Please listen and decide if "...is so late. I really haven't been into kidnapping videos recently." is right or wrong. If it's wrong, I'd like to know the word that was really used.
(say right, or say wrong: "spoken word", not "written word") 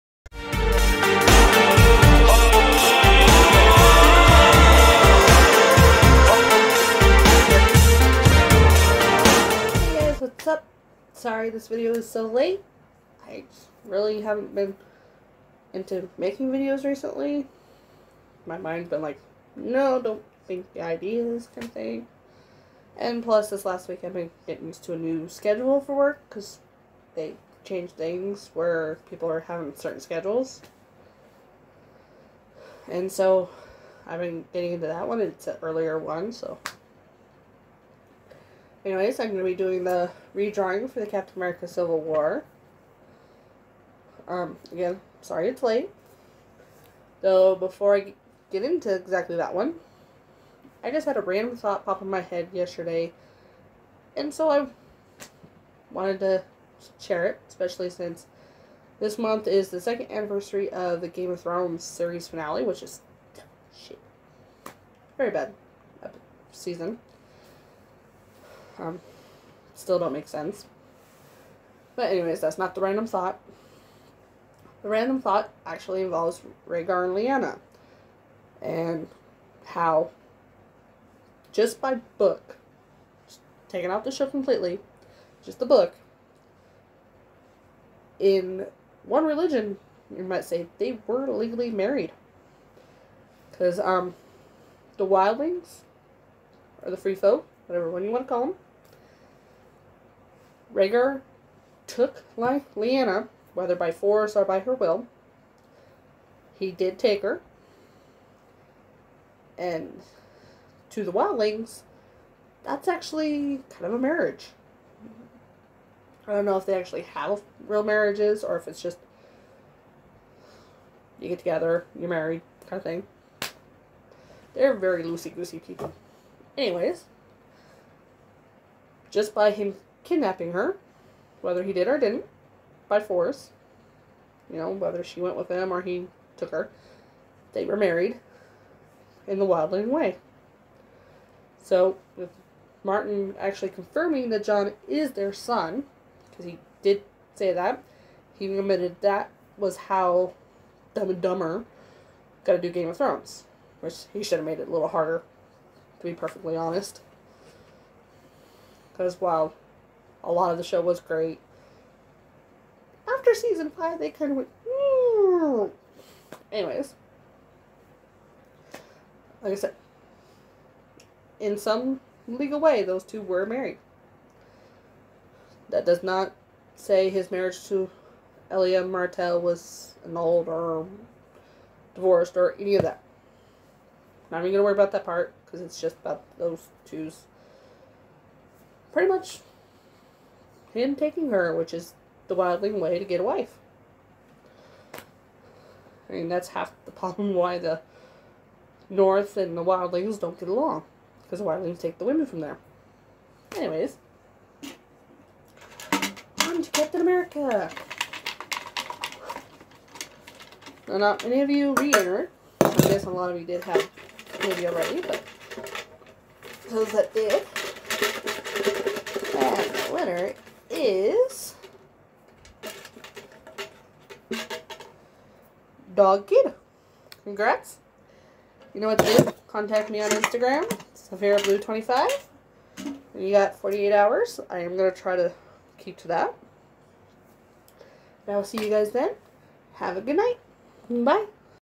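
wrong: "making", not "kidnapping".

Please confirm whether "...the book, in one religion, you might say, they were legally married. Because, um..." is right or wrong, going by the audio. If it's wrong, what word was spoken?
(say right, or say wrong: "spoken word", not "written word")
right.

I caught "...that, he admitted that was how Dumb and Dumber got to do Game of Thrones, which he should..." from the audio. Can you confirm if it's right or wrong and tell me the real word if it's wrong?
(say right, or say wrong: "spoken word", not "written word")
right.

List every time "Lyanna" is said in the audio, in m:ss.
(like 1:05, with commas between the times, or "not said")
1:17, 1:42.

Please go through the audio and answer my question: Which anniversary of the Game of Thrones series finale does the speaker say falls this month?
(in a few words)
second.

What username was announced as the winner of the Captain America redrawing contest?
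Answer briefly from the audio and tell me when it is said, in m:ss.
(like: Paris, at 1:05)
Dog Kid, at 3:45.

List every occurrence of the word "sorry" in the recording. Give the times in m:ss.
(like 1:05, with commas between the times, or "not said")
0:11, 0:45.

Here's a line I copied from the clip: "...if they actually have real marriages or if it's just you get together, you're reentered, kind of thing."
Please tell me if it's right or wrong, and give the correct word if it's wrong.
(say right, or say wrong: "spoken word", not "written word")
wrong: "married", not "reentered".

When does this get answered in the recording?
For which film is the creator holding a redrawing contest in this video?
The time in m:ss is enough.
0:41.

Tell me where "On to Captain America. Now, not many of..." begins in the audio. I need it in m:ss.
3:26.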